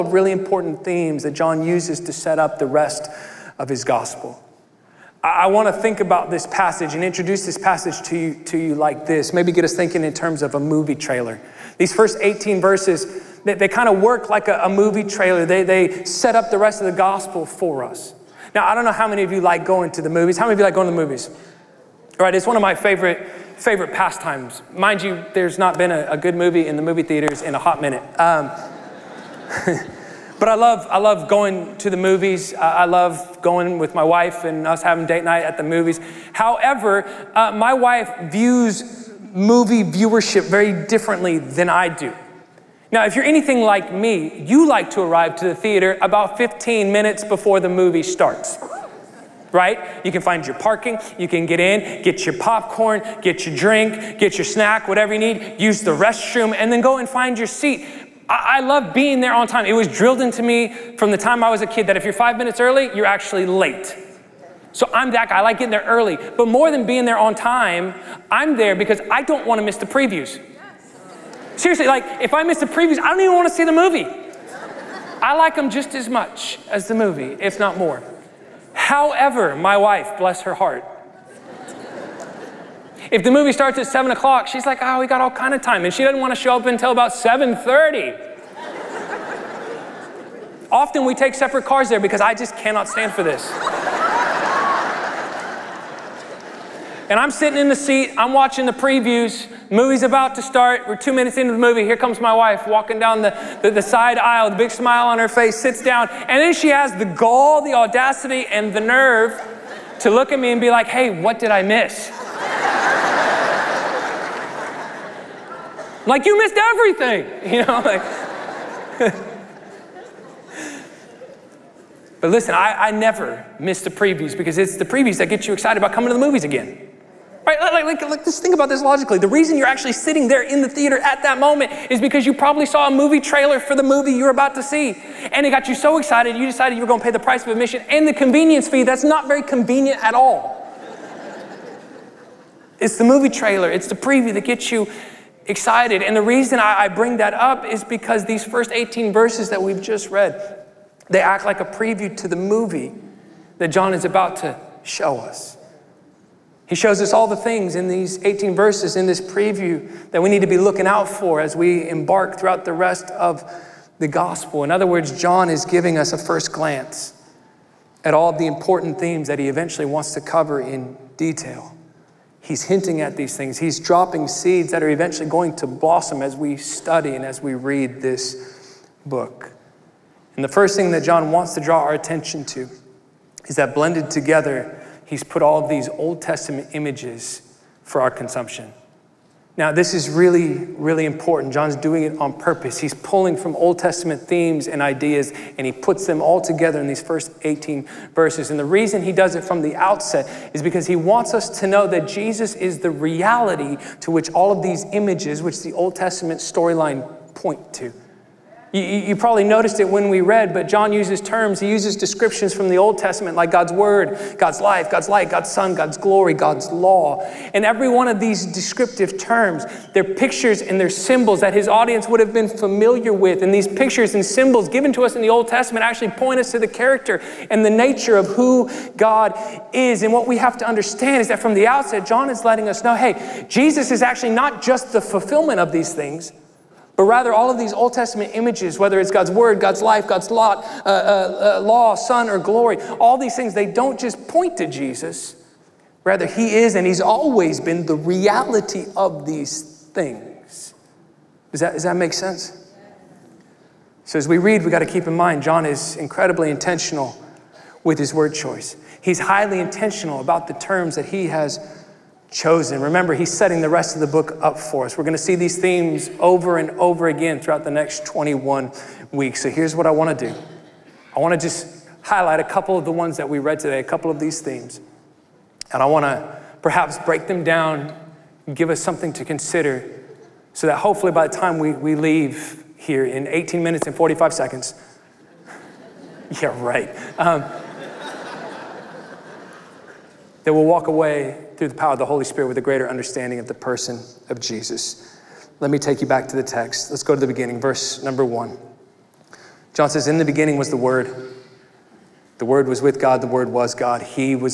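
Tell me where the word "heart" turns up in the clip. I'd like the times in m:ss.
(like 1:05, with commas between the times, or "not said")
1:20.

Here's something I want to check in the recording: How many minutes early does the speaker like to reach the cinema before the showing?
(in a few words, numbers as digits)
15 minutes.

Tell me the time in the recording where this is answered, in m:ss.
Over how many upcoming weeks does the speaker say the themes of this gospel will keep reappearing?
4:28.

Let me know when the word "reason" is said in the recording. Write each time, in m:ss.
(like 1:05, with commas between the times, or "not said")
2:09, 2:26, 3:18.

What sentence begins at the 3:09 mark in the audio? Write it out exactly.
Now, this is really, really important.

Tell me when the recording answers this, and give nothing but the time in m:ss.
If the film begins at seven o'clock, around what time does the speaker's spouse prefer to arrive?
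1:27.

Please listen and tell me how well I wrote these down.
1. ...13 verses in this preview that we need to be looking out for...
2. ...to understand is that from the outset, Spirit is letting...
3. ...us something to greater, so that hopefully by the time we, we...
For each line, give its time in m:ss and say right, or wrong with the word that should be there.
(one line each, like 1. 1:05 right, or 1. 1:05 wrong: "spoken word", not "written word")
1. 2:38 wrong: "18", not "13"
2. 3:50 wrong: "John", not "Spirit"
3. 4:38 wrong: "consider", not "greater".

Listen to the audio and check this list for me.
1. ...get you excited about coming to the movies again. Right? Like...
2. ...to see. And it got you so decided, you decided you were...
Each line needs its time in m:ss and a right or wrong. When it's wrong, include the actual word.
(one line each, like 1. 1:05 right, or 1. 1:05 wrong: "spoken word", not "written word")
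1. 2:05 right
2. 2:14 wrong: "excited", not "decided".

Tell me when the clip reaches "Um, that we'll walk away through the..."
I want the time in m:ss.
4:47.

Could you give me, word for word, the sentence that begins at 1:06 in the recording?
But more than being there on time, I'm there because I don't want to miss the previews.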